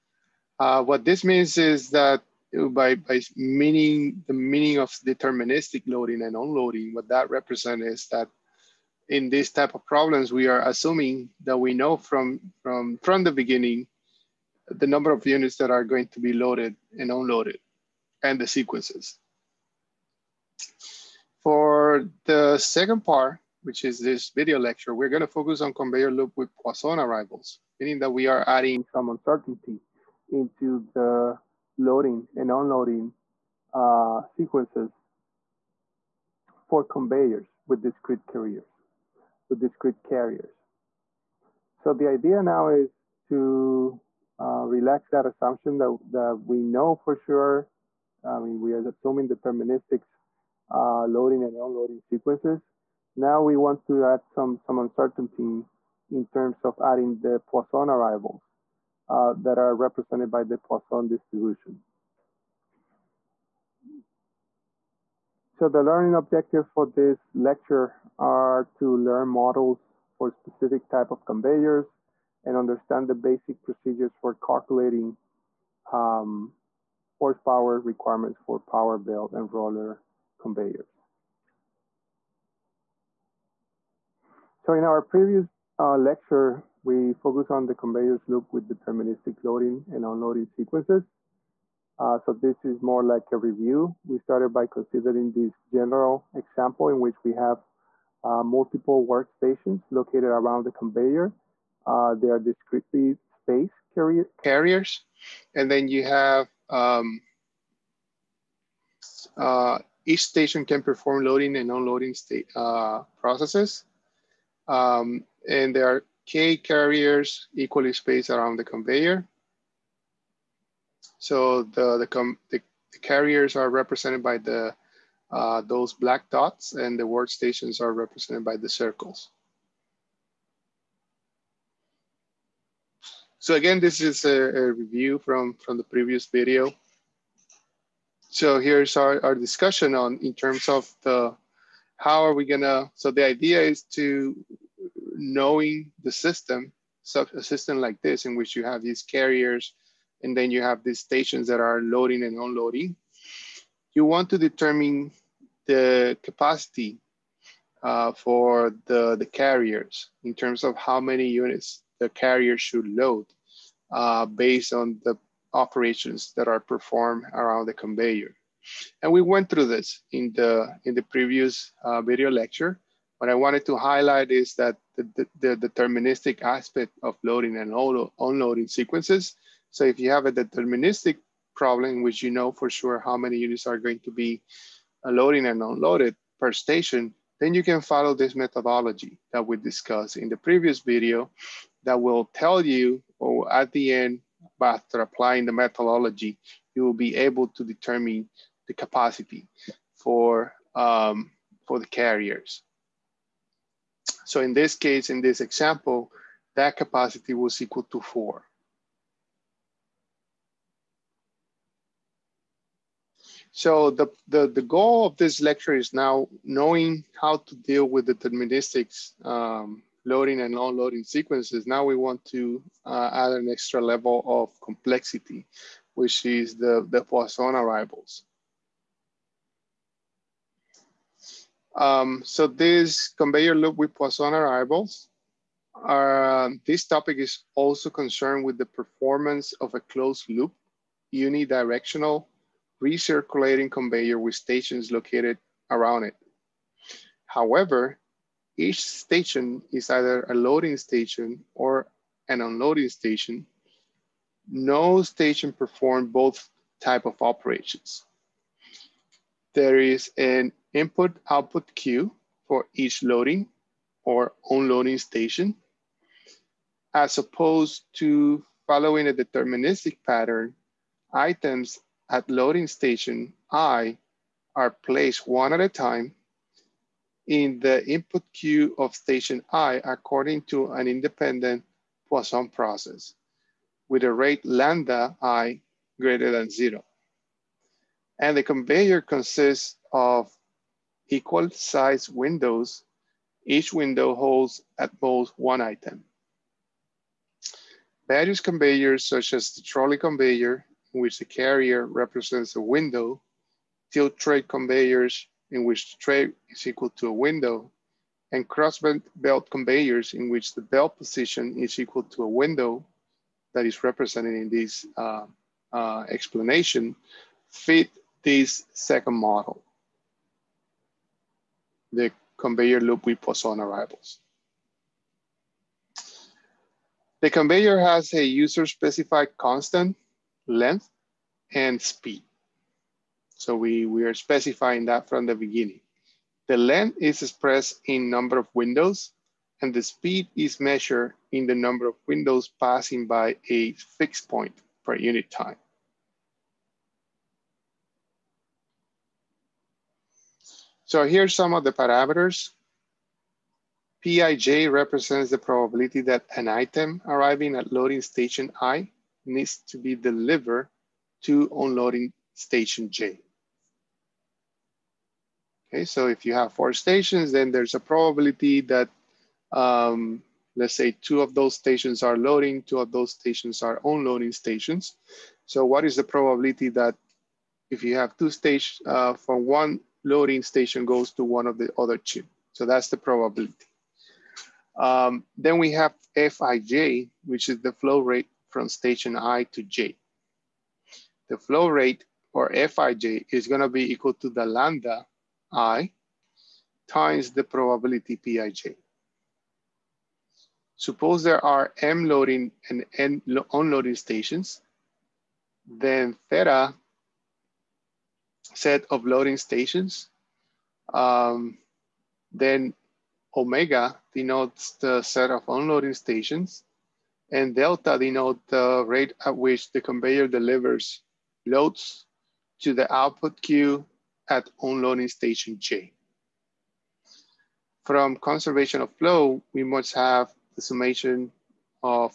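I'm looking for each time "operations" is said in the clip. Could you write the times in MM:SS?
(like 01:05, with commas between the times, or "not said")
02:45, 04:17.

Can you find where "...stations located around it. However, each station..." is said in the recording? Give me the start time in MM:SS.
04:04.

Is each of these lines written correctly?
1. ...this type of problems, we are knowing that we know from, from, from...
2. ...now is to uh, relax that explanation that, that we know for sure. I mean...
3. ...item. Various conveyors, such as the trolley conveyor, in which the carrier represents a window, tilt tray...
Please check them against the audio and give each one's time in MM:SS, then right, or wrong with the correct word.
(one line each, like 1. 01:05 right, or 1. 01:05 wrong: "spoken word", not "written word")
1. 00:09 wrong: "assuming", not "knowing"
2. 00:42 wrong: "assumption", not "explanation"
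3. 04:55 right.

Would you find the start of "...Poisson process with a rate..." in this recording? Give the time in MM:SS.
04:42.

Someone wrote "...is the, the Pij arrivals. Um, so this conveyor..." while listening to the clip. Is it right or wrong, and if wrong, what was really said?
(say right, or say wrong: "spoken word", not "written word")
wrong: "Poisson", not "Pij".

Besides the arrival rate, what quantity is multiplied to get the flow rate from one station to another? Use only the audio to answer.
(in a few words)
Probability Pij.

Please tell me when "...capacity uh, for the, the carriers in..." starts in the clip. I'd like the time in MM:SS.
02:36.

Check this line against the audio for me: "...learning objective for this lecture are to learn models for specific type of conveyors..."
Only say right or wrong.
right.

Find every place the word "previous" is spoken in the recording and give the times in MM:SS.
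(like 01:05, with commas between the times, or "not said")
01:25, 02:15, 02:51, 03:10.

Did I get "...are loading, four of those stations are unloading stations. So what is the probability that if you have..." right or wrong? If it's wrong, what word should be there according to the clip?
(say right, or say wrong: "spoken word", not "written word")
wrong: "two", not "four".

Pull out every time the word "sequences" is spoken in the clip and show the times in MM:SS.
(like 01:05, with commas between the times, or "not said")
00:18, 00:34, 00:51, 01:30, 02:58, 03:41.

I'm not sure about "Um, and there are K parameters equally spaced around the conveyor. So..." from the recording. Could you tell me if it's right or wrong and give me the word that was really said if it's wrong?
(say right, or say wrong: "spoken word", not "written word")
wrong: "carriers", not "parameters".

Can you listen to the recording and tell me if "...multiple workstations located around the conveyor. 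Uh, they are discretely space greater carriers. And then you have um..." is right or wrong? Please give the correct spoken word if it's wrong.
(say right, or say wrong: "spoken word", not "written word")
wrong: "carrier", not "greater".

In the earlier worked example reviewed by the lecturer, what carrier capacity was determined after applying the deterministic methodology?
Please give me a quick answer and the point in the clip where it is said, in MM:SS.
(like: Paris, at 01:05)
4, at 03:26.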